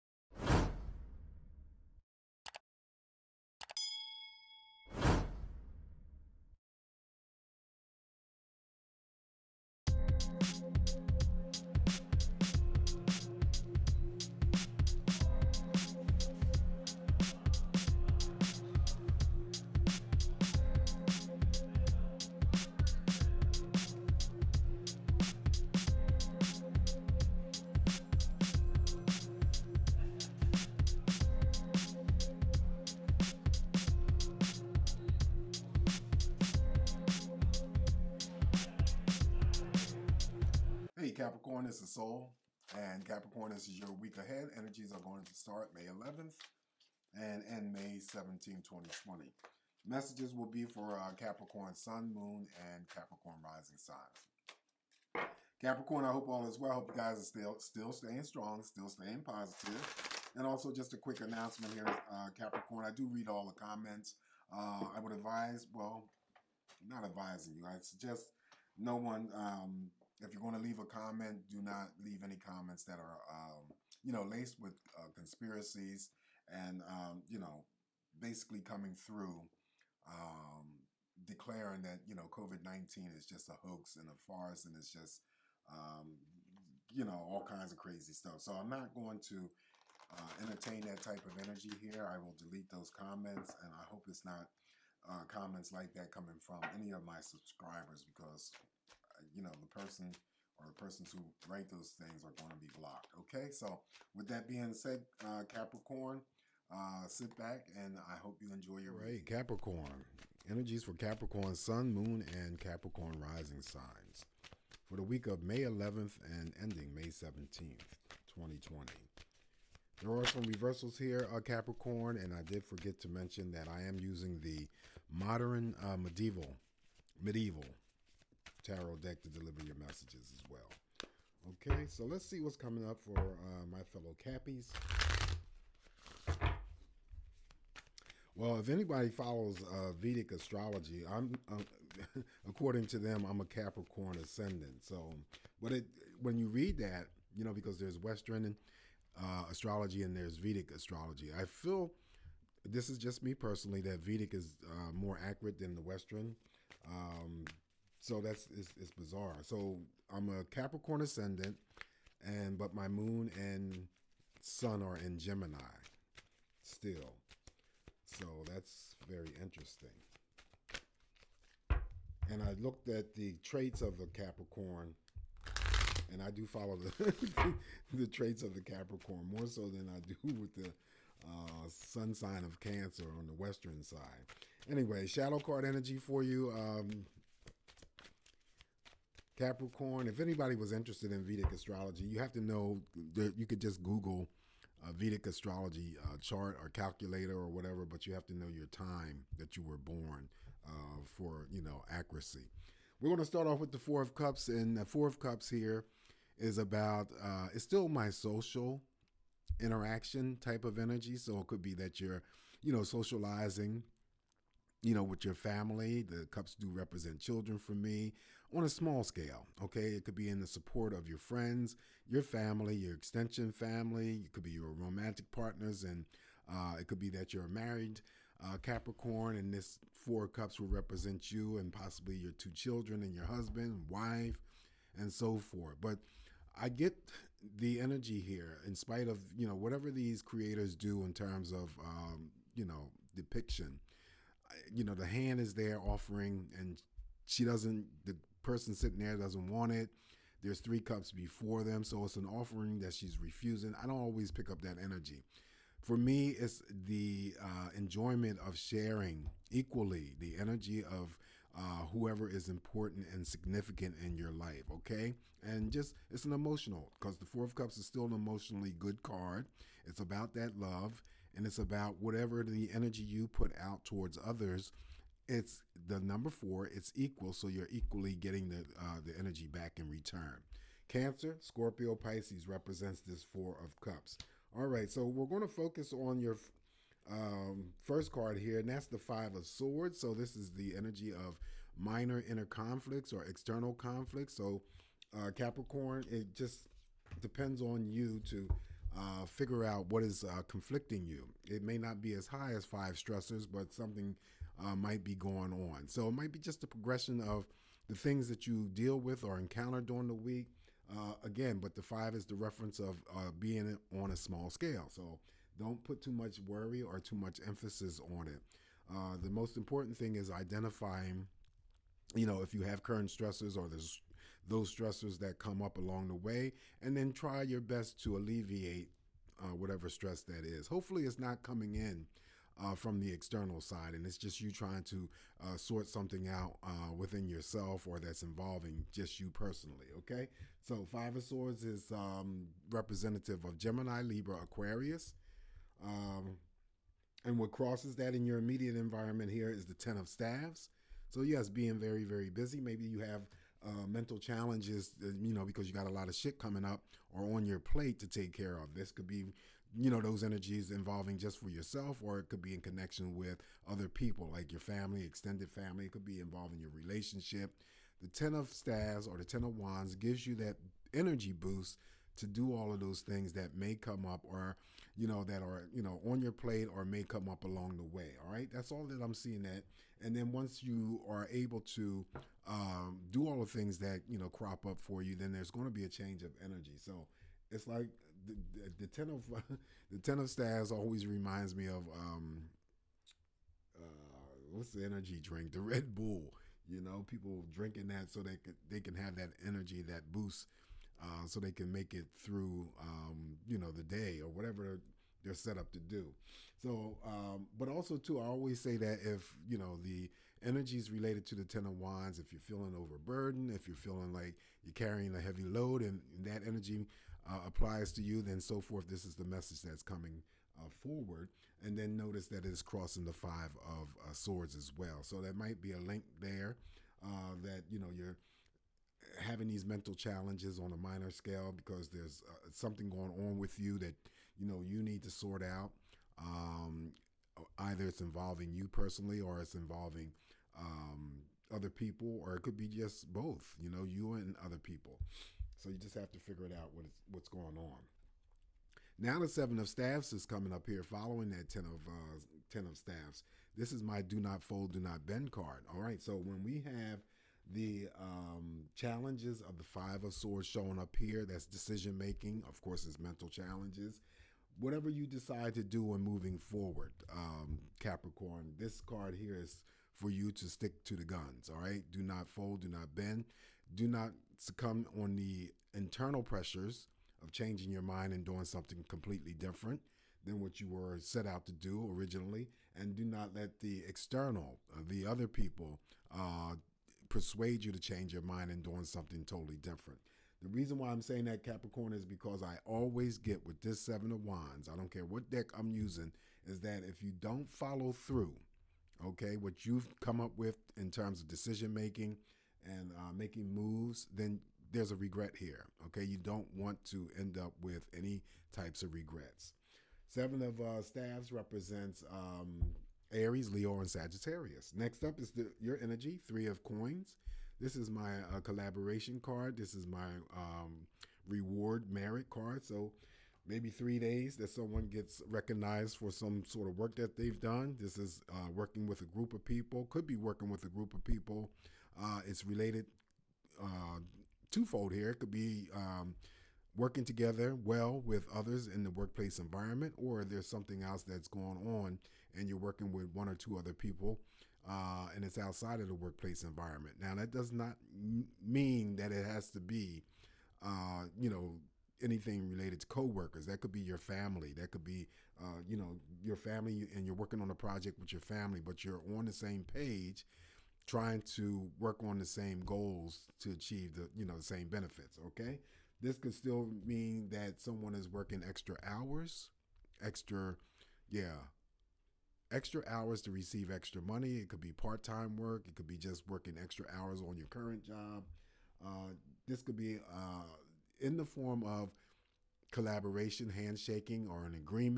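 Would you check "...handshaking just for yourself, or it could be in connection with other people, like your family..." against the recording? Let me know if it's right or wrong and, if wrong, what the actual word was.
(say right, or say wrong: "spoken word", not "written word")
wrong: "involving", not "handshaking".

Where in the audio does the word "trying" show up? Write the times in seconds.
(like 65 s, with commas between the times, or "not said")
334 s, 560 s.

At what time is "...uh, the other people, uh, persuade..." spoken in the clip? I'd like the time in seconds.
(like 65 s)
484 s.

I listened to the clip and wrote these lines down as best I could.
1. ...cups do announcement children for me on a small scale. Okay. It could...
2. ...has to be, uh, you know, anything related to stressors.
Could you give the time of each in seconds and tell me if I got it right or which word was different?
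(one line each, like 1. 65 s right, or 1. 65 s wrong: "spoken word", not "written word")
1. 216 s wrong: "represent", not "announcement"
2. 549 s wrong: "coworkers", not "stressors".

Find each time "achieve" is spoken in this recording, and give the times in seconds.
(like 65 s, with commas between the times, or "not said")
563 s.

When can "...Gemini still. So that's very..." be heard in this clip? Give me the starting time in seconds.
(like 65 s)
165 s.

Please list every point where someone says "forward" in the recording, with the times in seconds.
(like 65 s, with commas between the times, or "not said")
420 s, 466 s.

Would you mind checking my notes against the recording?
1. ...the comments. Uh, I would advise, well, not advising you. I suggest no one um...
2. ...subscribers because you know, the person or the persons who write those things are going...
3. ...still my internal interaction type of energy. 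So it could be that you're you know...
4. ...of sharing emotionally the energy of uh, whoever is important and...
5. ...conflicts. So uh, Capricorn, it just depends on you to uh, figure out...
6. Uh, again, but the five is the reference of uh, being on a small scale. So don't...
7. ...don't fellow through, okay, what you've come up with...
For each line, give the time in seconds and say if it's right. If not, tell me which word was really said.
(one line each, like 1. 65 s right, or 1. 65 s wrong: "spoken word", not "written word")
1. 63 s right
2. 97 s right
3. 207 s wrong: "social", not "internal"
4. 258 s wrong: "equally", not "emotionally"
5. 293 s right
6. 310 s right
7. 497 s wrong: "follow", not "fellow".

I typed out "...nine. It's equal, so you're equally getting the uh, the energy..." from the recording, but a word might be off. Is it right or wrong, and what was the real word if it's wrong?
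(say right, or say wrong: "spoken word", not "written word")
wrong: "four", not "nine".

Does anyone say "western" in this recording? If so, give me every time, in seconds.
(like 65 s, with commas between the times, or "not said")
147 s, 155 s, 183 s.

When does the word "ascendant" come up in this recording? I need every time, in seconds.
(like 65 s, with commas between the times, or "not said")
144 s, 161 s.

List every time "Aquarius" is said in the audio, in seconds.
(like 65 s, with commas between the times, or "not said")
344 s.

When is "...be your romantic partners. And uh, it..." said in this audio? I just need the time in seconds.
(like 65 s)
224 s.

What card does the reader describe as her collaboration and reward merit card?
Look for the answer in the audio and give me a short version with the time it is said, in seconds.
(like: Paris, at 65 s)
Three of Coins, at 516 s.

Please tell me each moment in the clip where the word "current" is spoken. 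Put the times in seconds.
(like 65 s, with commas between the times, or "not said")
322 s, 577 s.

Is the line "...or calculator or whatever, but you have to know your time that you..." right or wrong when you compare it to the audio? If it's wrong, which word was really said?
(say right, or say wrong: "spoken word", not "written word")
right.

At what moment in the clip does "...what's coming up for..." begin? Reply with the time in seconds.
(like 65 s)
132 s.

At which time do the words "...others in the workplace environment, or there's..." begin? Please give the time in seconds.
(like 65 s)
538 s.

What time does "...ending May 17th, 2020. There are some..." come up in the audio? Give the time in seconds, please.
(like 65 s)
116 s.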